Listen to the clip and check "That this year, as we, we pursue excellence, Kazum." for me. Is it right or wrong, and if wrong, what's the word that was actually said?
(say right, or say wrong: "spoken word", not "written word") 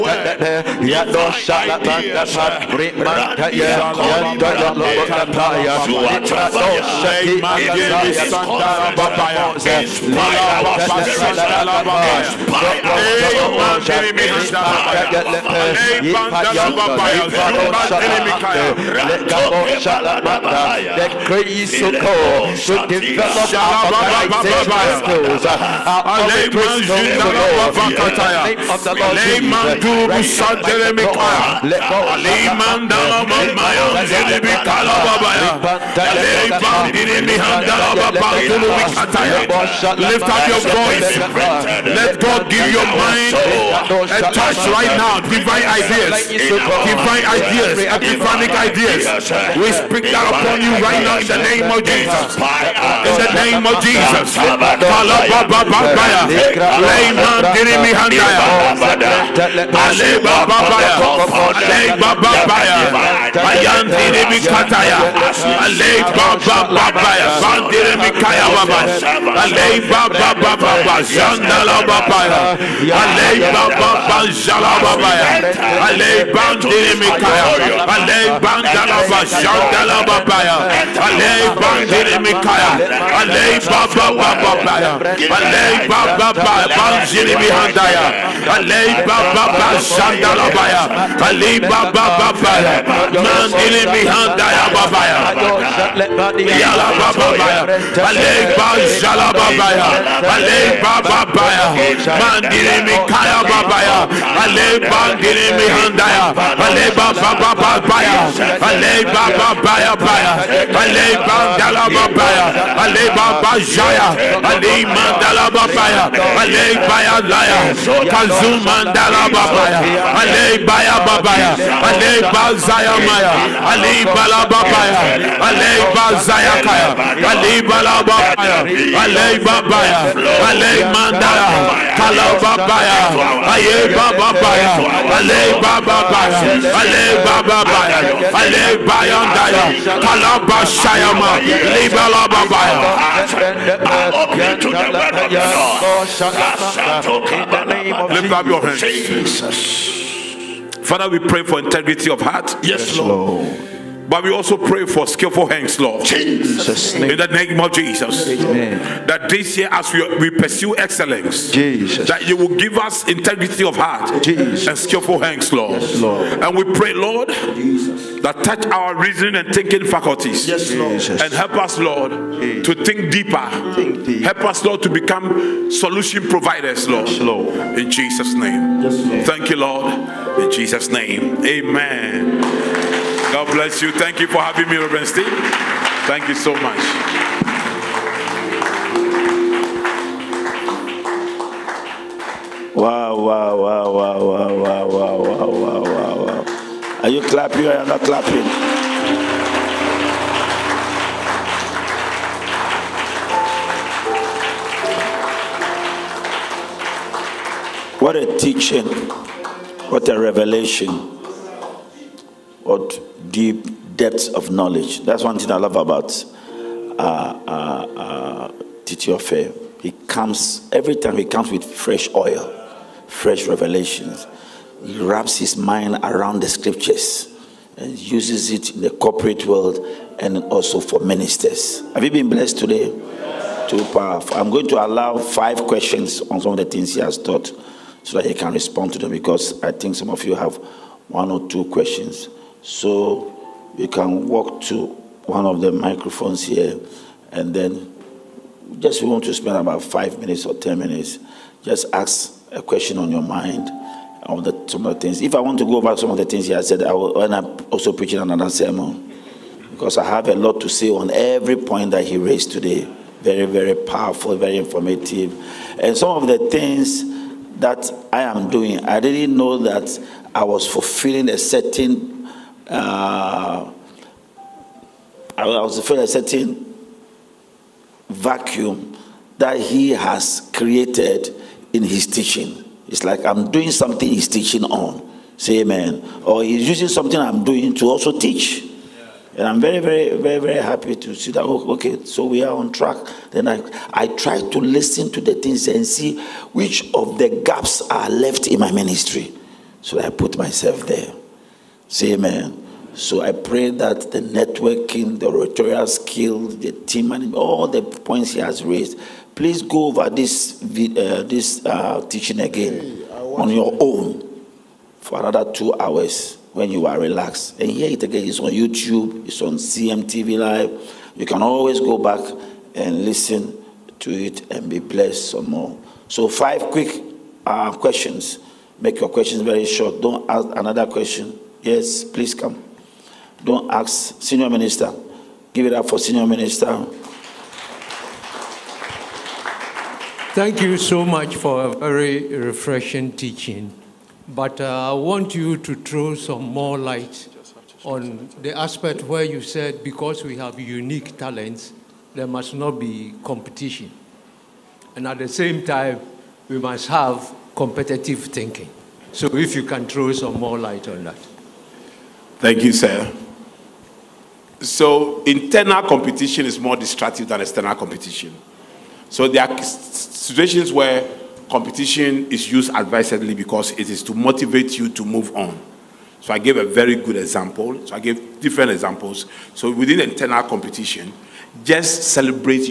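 wrong: "Jesus", not "Kazum".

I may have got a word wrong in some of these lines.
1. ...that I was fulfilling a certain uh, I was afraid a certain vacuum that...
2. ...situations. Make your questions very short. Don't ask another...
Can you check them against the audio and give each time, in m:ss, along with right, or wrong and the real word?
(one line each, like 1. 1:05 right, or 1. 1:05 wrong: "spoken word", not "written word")
1. 4:29 right
2. 5:27 wrong: "questions", not "situations".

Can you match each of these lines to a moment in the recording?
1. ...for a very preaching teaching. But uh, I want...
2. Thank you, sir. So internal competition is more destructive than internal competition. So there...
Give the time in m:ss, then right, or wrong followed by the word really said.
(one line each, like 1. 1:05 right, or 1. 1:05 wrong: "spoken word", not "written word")
1. 5:41 wrong: "refreshing", not "preaching"
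2. 6:02 wrong: "external", not "internal".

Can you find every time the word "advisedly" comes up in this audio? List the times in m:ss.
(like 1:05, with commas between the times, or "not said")
6:12.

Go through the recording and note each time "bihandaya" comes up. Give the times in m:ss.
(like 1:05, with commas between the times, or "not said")
1:27, 1:33, 1:45.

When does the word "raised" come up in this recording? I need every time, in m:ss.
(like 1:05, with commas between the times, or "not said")
4:22, 5:08.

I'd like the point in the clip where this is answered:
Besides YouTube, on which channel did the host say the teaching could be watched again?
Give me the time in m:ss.
5:19.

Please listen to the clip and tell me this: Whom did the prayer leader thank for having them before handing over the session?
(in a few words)
Reverend Steve.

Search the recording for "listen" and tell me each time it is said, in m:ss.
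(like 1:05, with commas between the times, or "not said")
4:54, 5:23.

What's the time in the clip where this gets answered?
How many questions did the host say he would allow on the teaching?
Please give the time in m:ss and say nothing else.
3:55.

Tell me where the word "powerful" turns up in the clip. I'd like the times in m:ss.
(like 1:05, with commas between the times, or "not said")
3:53, 4:23.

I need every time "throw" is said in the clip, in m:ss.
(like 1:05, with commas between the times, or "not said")
5:45, 5:59.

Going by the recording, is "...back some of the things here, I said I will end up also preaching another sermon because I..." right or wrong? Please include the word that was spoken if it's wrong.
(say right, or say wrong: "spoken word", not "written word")
right.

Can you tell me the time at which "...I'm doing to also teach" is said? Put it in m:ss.
4:47.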